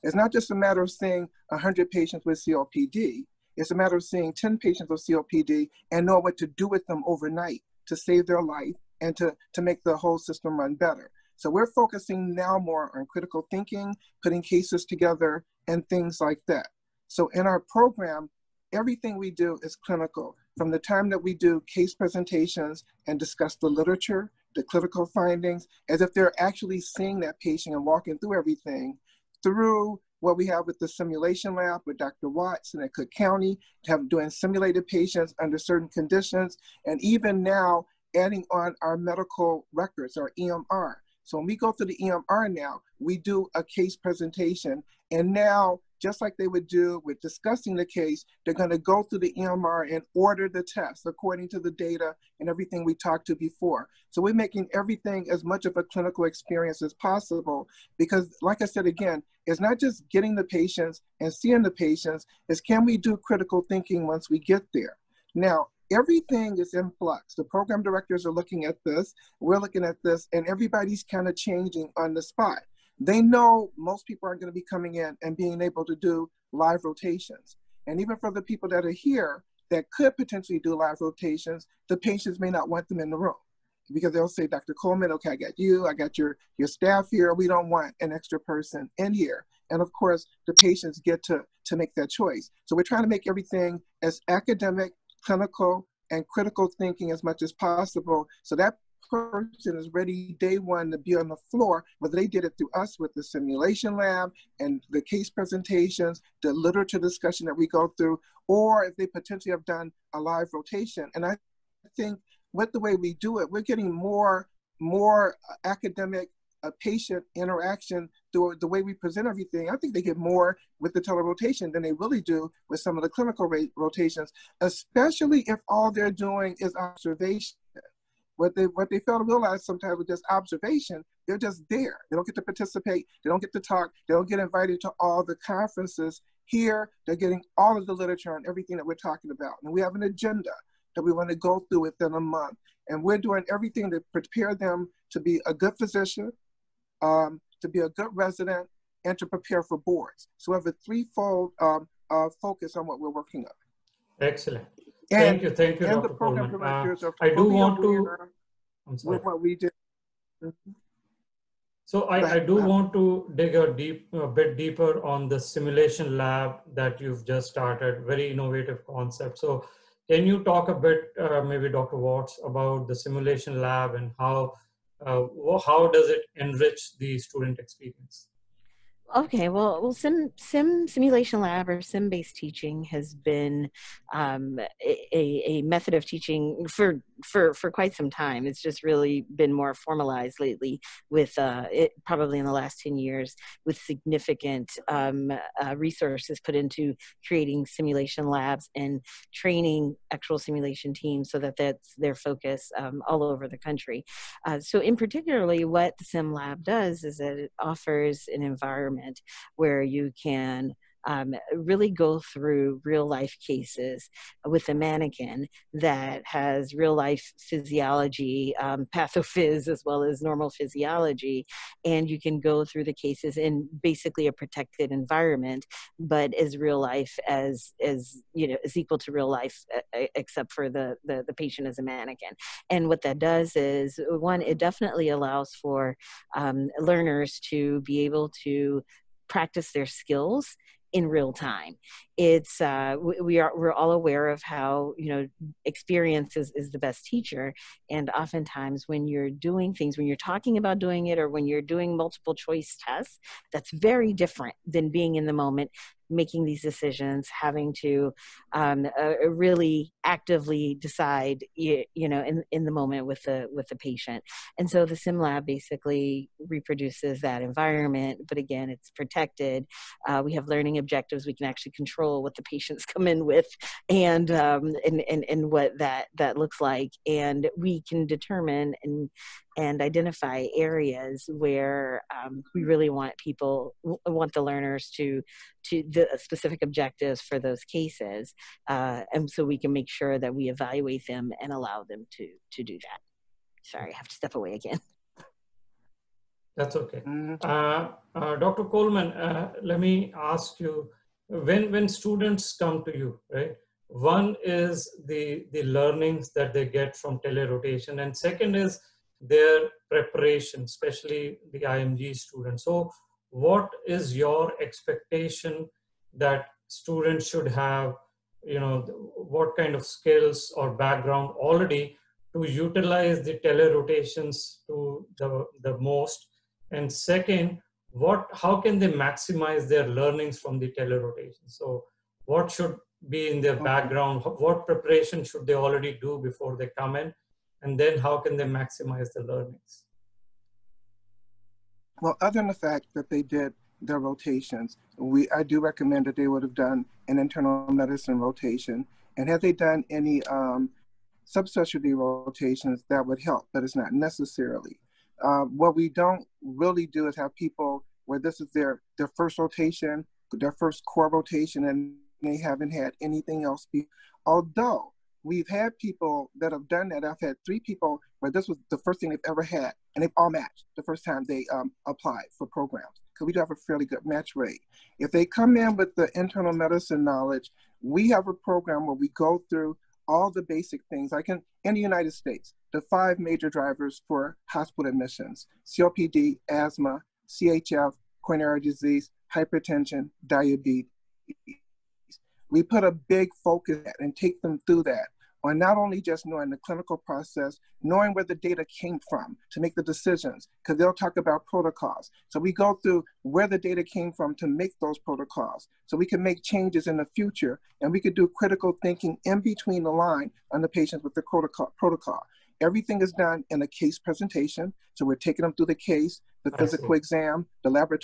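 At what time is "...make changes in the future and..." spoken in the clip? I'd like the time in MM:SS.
06:46.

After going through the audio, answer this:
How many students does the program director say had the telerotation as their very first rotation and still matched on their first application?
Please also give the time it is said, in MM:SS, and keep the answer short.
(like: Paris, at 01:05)
3, at 06:07.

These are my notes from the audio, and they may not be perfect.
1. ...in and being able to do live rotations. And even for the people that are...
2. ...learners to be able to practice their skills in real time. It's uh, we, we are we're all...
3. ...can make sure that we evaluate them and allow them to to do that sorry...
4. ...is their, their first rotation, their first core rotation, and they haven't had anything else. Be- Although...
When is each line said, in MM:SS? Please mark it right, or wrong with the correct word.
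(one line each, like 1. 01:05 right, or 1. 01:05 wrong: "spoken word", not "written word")
1. 01:14 right
2. 03:56 right
3. 04:49 right
4. 05:58 right.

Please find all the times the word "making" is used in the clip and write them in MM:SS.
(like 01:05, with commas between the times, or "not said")
00:54, 04:16.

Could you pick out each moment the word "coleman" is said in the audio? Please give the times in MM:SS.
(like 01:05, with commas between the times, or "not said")
01:24, 04:58.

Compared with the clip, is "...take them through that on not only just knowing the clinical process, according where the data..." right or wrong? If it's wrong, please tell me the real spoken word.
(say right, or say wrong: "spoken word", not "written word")
wrong: "knowing", not "according".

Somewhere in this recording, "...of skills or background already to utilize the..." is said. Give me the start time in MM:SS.
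05:19.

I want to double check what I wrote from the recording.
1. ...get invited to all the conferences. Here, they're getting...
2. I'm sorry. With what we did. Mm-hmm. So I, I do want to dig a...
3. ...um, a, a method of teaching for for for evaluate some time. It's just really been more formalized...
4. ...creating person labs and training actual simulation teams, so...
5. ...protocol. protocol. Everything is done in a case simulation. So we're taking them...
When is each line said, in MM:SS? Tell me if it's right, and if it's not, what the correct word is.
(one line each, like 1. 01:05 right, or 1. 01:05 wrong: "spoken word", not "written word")
1. 02:14 right
2. 02:38 right
3. 03:04 wrong: "quite", not "evaluate"
4. 03:17 wrong: "simulation", not "person"
5. 06:51 wrong: "presentation", not "simulation".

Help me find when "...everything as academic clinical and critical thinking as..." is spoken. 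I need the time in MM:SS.
01:33.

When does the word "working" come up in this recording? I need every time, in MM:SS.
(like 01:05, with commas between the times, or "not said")
02:33.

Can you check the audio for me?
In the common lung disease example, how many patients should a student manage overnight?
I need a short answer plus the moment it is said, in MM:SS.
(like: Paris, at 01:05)
10, at 00:04.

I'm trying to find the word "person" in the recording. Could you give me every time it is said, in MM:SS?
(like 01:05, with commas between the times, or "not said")
01:28, 01:39.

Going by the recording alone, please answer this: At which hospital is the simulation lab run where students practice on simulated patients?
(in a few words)
Cook County.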